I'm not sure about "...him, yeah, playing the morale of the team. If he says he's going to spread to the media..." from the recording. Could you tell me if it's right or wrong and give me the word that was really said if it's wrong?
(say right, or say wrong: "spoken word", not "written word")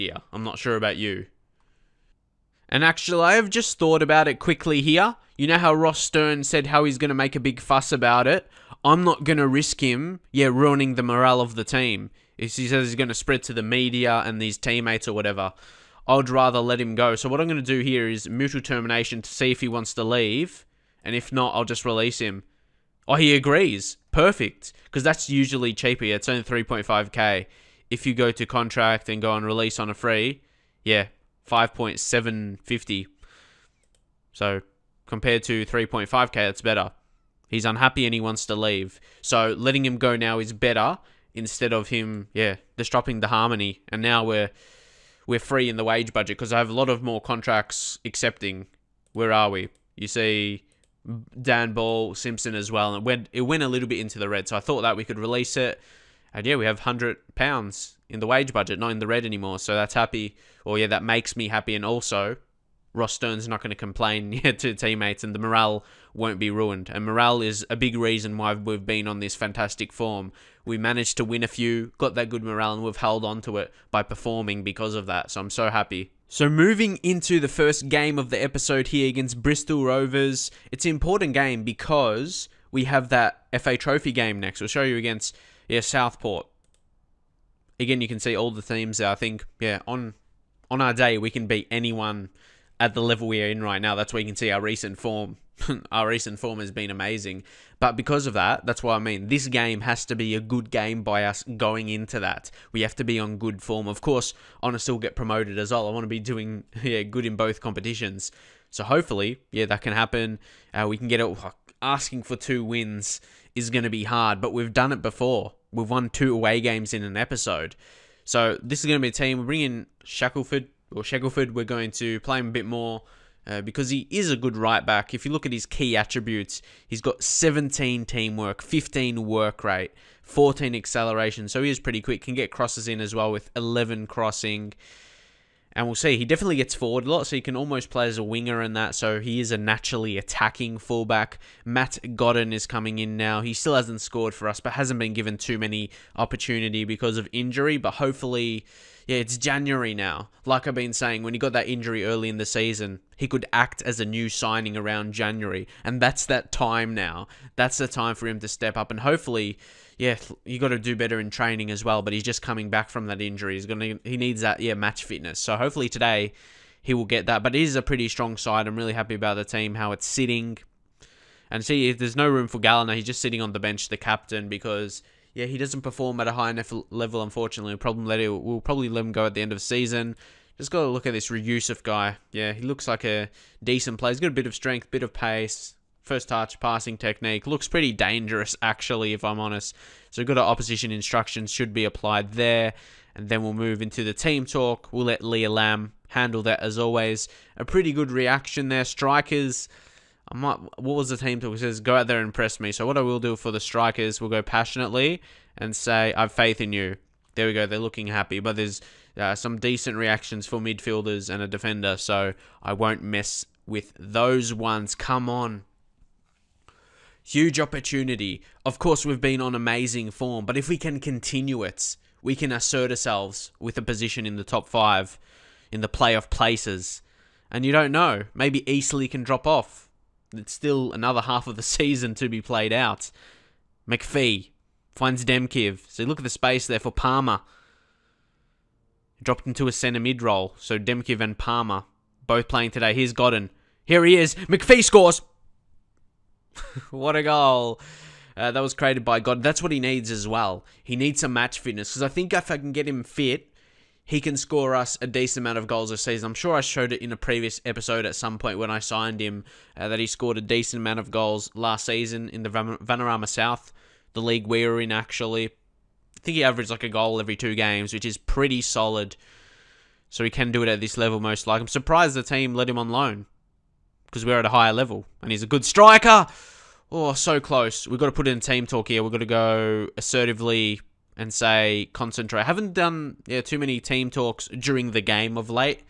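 wrong: "ruining", not "playing".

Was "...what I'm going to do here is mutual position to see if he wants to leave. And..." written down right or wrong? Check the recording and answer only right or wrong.
wrong.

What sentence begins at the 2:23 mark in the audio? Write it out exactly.
He still hasn't scored for us, but hasn't been given too many opportunity because of injury.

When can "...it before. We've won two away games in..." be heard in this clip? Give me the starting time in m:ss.
1:54.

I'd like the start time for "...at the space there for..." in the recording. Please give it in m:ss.
3:56.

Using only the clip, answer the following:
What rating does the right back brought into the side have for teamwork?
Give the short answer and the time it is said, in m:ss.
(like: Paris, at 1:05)
17, at 2:07.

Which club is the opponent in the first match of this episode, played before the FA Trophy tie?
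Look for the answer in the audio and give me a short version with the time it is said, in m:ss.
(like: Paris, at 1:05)
Bristol Rovers, at 1:19.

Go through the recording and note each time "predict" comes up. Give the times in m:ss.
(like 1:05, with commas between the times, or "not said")
not said.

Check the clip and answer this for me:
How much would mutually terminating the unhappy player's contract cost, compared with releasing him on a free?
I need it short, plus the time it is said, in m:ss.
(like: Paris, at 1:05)
3.5k, at 0:26.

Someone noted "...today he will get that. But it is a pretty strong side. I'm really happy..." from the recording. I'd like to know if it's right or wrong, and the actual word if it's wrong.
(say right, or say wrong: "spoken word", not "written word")
right.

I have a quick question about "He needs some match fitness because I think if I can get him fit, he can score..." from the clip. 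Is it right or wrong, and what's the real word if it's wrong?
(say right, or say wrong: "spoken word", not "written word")
right.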